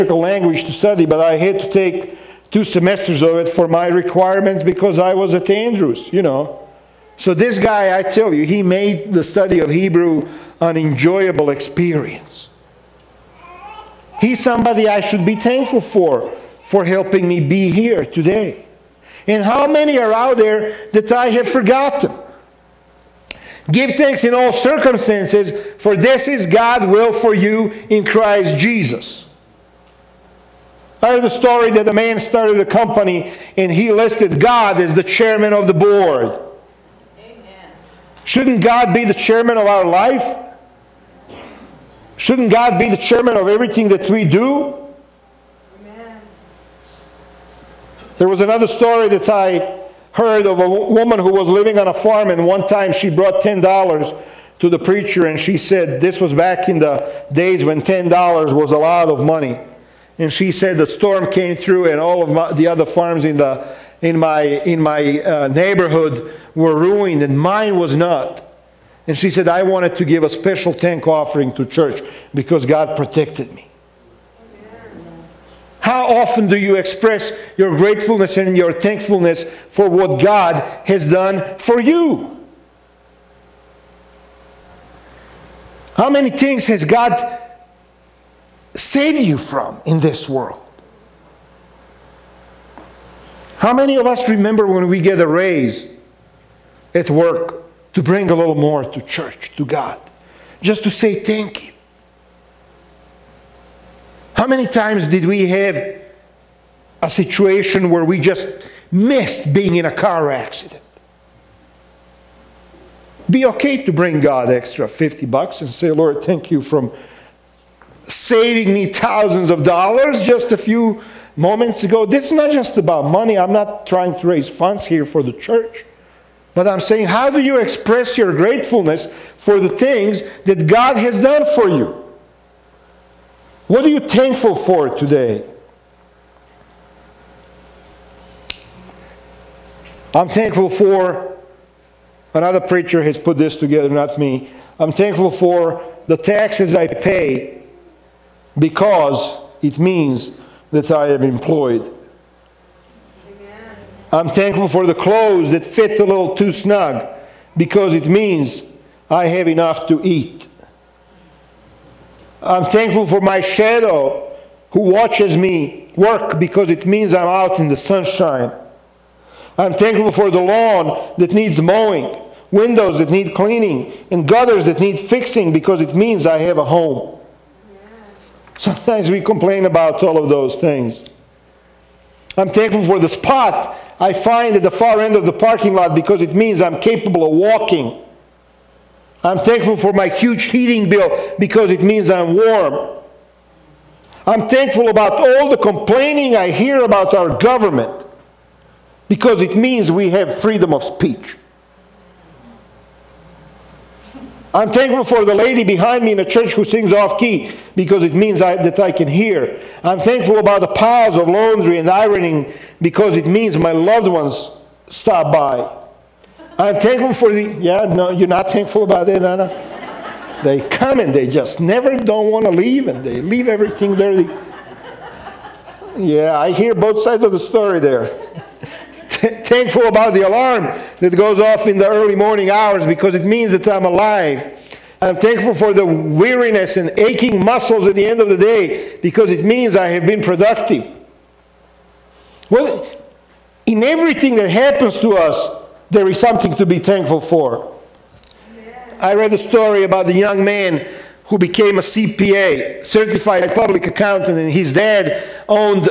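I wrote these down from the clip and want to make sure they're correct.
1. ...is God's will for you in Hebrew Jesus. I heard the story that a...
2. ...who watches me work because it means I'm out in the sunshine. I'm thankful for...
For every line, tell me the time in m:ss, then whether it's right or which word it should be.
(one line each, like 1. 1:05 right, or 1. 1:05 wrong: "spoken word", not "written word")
1. 0:26 wrong: "Christ", not "Hebrew"
2. 2:44 right.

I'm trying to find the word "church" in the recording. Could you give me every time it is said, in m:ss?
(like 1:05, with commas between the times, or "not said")
1:11, 1:39, 2:05, 3:26.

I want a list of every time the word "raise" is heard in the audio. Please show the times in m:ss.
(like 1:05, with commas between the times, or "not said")
1:35, 2:04.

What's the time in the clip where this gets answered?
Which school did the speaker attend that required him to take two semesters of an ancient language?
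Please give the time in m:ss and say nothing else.
0:05.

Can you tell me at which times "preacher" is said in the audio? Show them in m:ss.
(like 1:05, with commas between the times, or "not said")
0:54, 2:22.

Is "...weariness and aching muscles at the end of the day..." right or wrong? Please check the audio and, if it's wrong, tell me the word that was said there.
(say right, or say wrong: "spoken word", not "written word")
right.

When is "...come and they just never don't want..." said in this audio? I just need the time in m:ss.
3:40.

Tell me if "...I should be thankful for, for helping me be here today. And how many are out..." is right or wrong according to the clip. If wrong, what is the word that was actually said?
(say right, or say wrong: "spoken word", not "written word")
right.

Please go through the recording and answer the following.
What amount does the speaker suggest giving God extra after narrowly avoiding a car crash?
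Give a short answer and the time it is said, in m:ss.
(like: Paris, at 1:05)
50 bucks, at 1:54.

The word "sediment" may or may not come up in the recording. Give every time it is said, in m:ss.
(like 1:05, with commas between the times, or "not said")
not said.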